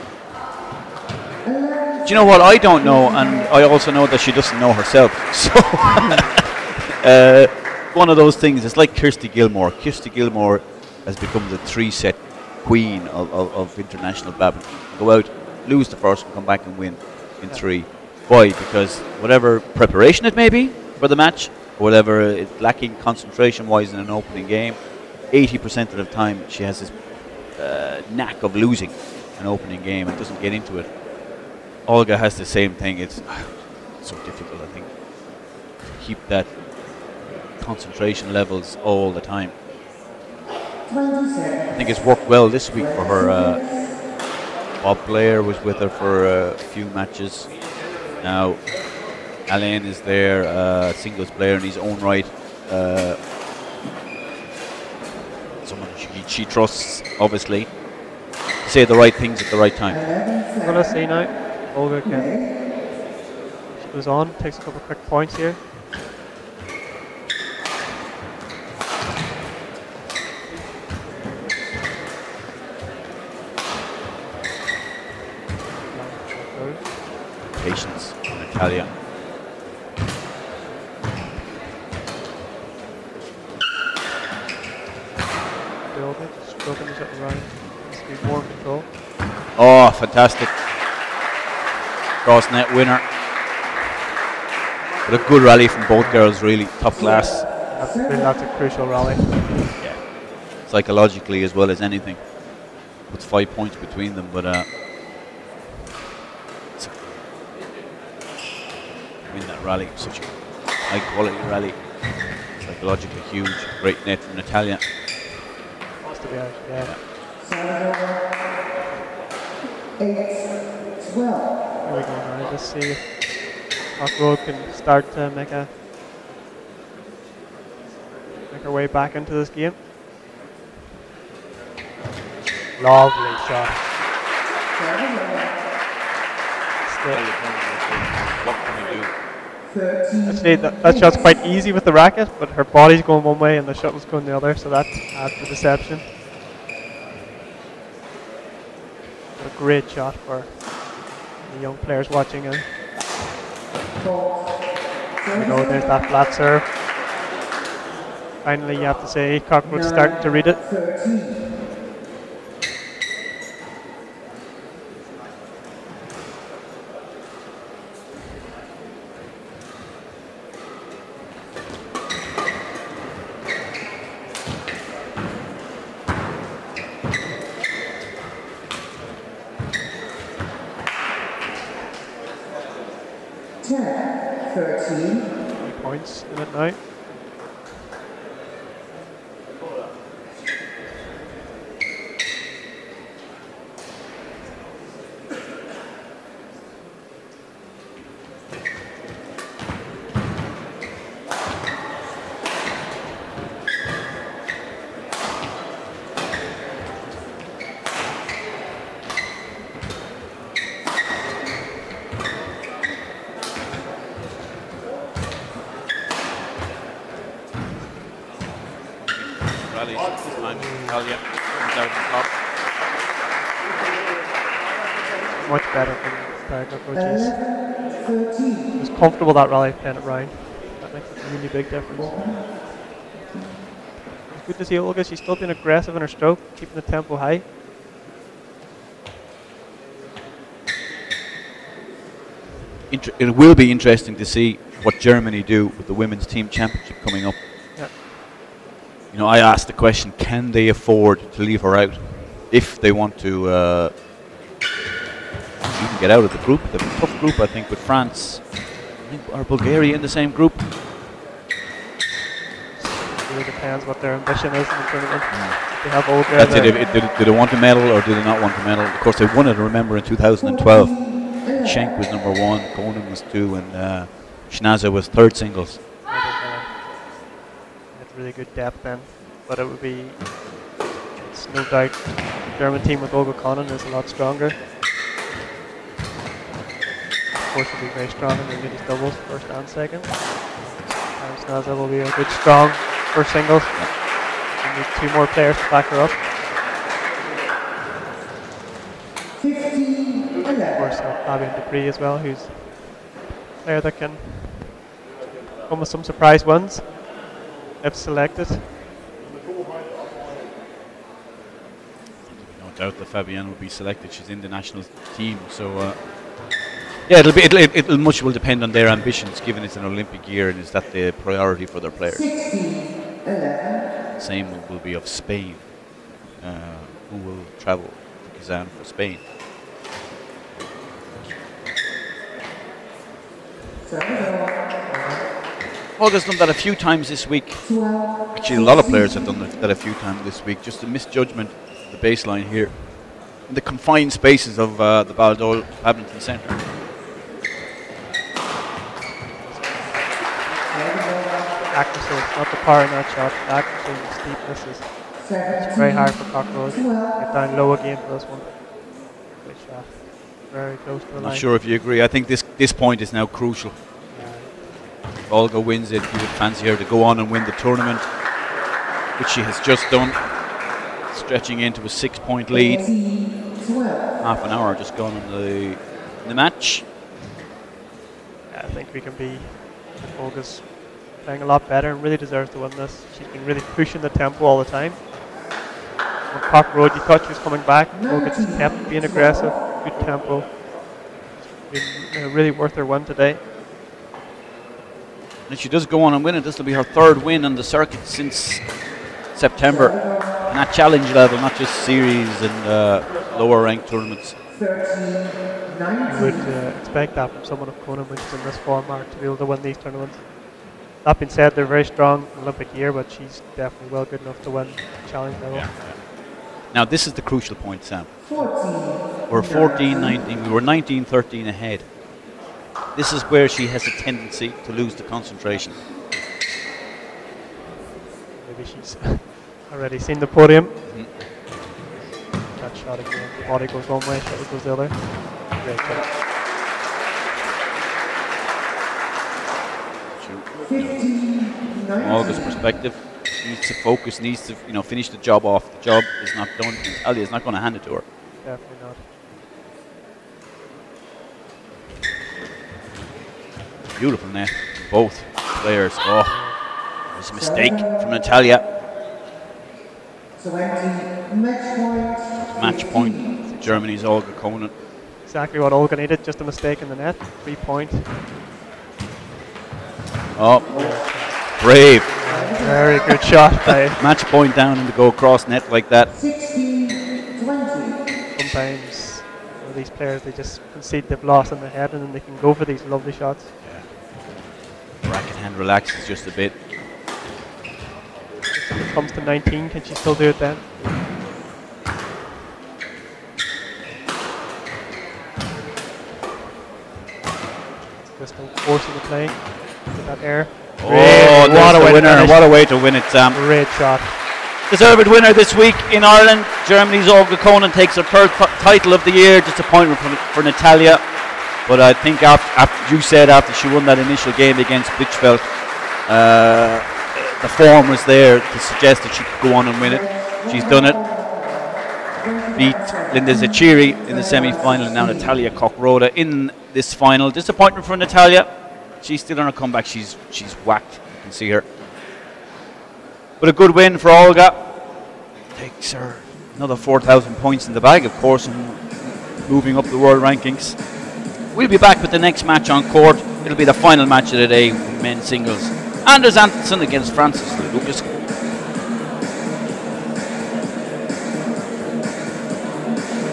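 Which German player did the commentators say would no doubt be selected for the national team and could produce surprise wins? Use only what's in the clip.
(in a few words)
Fabienne Deprez.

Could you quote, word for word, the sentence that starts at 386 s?
On Park Road, you thought she was coming back.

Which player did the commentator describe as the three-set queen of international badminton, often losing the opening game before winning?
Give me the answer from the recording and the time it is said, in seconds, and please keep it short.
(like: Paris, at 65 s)
Kirsty Gilmour, at 9 s.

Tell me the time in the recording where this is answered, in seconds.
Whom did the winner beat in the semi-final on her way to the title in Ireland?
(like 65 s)
523 s.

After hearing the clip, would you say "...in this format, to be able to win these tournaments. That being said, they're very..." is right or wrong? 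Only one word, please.
right.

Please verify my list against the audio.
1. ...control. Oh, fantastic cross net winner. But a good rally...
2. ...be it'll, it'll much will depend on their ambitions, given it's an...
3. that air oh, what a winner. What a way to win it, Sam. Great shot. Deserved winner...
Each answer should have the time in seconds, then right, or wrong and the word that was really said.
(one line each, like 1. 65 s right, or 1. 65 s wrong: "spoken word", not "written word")
1. 88 s right
2. 317 s right
3. 500 s right.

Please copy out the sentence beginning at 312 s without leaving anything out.
No doubt that Fabienne will be selected.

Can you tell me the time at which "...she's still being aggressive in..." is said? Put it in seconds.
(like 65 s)
235 s.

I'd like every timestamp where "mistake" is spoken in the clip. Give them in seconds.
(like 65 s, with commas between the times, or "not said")
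457 s, 466 s.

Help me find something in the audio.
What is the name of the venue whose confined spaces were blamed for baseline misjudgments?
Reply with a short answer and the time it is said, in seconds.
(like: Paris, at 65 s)
Baldoyle Badminton Centre, at 345 s.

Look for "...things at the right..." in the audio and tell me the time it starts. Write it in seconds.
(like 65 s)
59 s.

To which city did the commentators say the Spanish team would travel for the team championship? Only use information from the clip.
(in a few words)
Kazan.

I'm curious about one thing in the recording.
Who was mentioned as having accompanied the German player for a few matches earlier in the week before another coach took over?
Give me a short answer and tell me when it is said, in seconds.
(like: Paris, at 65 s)
Bob Blair, at 44 s.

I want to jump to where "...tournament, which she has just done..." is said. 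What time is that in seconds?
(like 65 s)
367 s.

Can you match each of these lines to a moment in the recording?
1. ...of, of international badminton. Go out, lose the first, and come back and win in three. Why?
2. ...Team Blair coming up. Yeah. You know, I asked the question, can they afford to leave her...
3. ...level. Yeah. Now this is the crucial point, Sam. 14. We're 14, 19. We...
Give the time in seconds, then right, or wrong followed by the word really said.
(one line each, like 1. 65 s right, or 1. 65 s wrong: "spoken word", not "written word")
1. 13 s right
2. 246 s wrong: "Championship", not "Blair"
3. 415 s right.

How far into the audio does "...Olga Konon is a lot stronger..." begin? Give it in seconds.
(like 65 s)
283 s.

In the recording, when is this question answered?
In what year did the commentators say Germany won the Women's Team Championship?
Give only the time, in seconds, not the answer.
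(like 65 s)
270 s.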